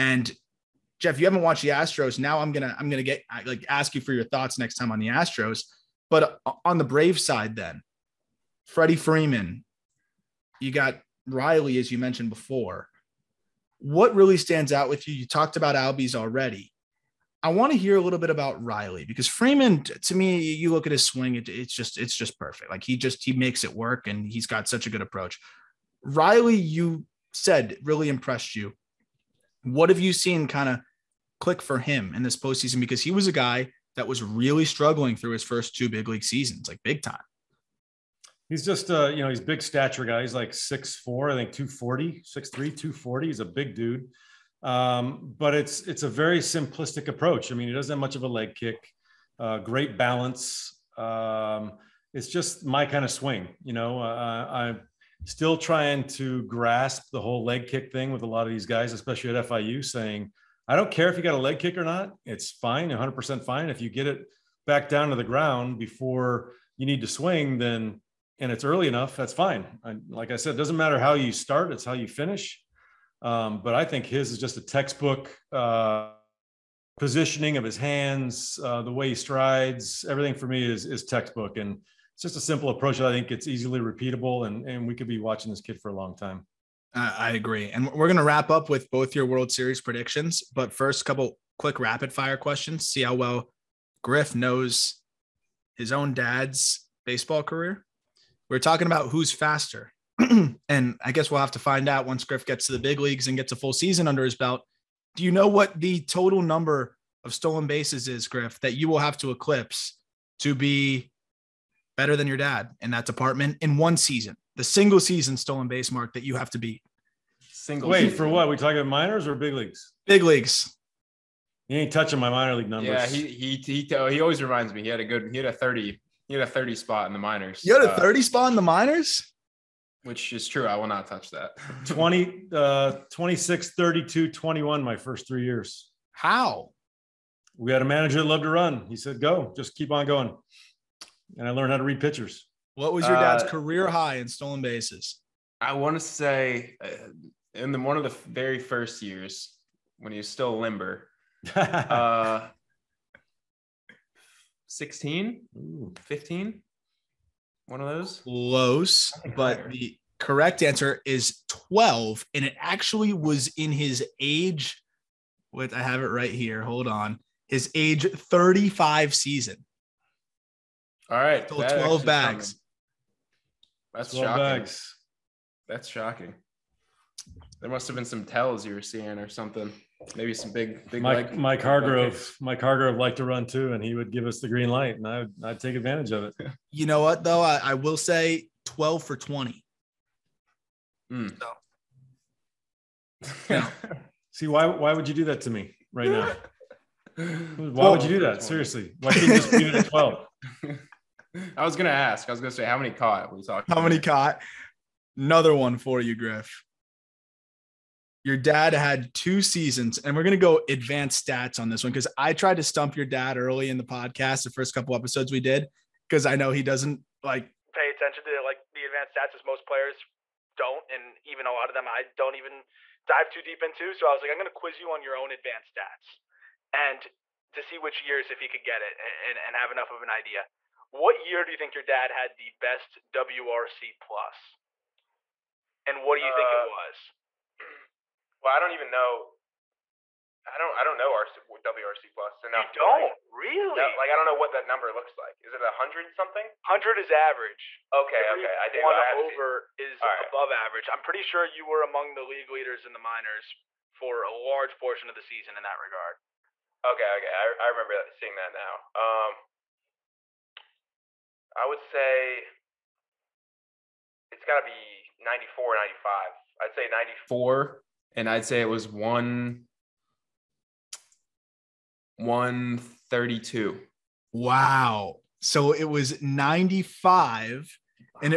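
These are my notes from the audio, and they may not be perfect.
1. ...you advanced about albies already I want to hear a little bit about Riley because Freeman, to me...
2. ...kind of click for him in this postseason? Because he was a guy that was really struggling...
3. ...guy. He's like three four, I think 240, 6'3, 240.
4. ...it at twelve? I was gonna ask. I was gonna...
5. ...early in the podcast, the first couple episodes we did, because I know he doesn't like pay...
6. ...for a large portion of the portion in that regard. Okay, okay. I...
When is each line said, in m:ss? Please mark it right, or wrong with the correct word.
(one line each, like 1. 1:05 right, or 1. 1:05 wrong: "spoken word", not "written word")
1. 0:15 wrong: "talked", not "advanced"
2. 0:30 right
3. 0:40 wrong: "six", not "three"
4. 3:19 right
5. 3:33 right
6. 4:13 wrong: "season", not "portion".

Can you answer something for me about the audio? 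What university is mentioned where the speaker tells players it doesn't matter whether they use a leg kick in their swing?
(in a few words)
FIU.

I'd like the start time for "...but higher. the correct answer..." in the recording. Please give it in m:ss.
2:39.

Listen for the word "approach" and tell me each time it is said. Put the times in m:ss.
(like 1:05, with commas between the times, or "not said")
0:25, 0:47, 1:22.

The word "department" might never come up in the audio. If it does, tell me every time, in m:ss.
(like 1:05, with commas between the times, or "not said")
1:53.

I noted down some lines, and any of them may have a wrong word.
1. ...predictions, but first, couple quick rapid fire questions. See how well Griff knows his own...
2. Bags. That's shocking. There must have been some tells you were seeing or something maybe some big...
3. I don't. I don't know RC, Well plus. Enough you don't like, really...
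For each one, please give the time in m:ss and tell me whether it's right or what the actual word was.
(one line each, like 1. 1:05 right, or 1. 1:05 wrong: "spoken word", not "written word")
1. 1:29 right
2. 2:54 right
3. 4:00 wrong: "WRC", not "Well".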